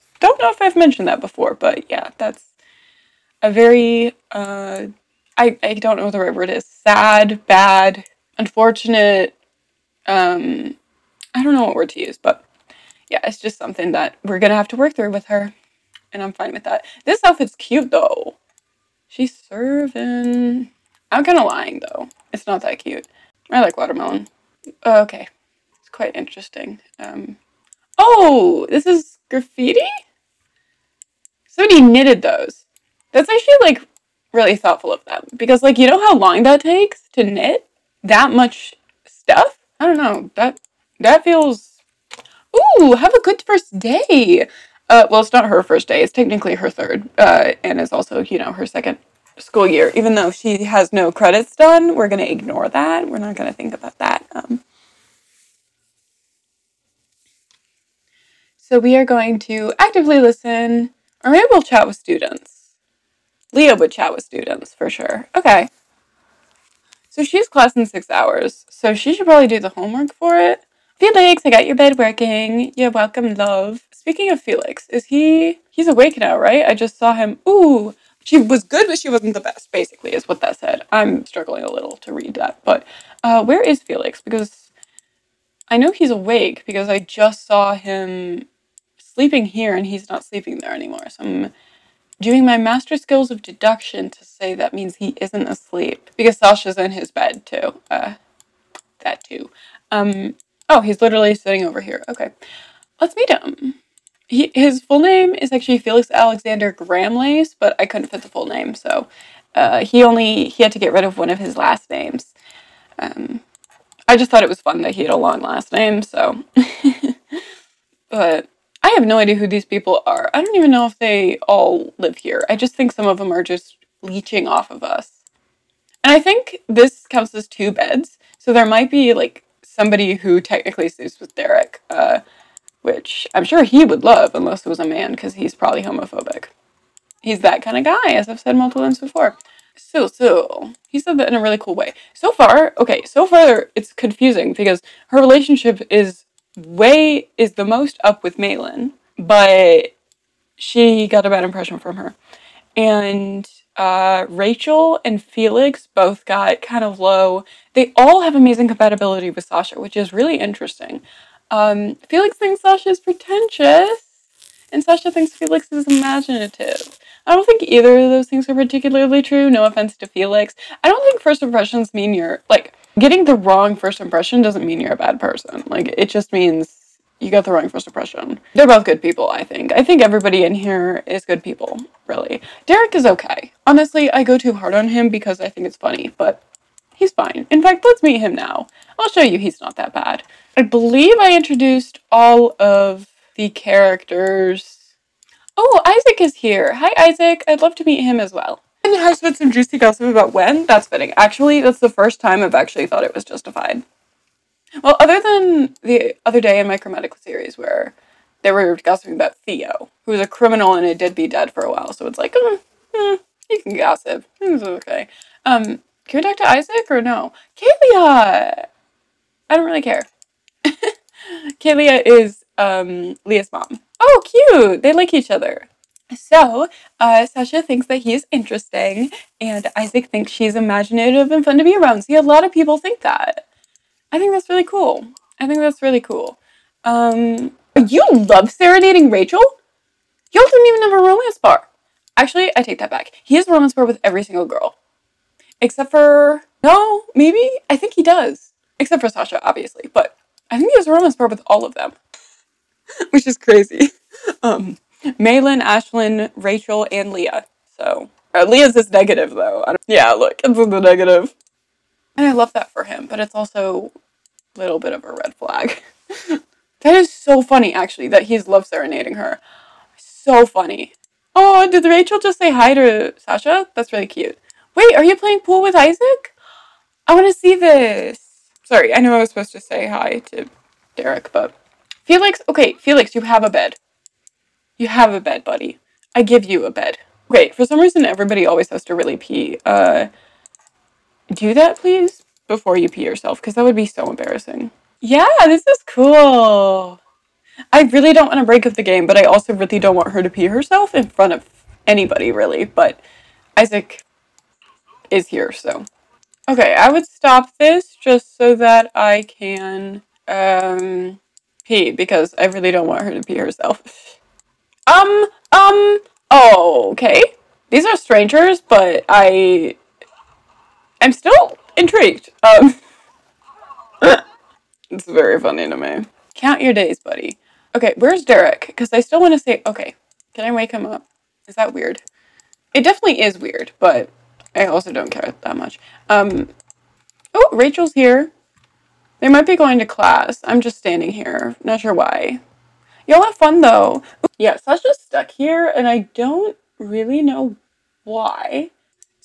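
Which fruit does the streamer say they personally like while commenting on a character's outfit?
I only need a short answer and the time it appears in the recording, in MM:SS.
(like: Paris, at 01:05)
Watermelon, at 00:23.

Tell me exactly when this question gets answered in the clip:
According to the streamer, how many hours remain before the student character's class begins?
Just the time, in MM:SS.
01:07.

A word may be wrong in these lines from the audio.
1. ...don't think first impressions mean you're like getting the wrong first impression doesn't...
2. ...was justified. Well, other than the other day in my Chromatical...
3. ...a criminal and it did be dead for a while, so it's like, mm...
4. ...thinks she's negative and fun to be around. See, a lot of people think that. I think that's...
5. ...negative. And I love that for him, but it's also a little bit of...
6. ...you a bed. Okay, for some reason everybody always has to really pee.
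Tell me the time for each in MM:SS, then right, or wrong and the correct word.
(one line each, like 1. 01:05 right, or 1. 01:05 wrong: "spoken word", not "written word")
1. 02:50 right
2. 03:23 right
3. 03:30 right
4. 03:50 wrong: "imaginative", not "negative"
5. 04:20 right
6. 04:46 right.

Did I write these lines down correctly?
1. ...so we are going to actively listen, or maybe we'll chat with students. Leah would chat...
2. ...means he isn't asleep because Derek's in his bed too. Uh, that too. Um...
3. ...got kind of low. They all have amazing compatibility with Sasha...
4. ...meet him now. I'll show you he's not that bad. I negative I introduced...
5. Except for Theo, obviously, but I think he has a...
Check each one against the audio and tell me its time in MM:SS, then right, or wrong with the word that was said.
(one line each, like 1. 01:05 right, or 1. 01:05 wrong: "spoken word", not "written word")
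1. 00:58 right
2. 01:34 wrong: "Sasha", not "Derek"
3. 02:36 right
4. 03:08 wrong: "believe", not "negative"
5. 04:08 wrong: "Sasha", not "Theo".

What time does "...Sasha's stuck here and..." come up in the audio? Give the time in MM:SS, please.
05:44.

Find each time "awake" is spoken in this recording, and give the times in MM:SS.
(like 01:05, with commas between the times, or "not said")
01:15, 01:26.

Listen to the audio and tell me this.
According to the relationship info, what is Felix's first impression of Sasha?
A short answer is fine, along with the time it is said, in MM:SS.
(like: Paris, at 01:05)
Pretentious, at 02:42.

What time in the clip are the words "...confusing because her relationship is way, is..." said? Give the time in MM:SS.
02:23.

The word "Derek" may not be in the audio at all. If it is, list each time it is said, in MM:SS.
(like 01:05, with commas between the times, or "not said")
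02:11, 03:02, 04:40, 05:28.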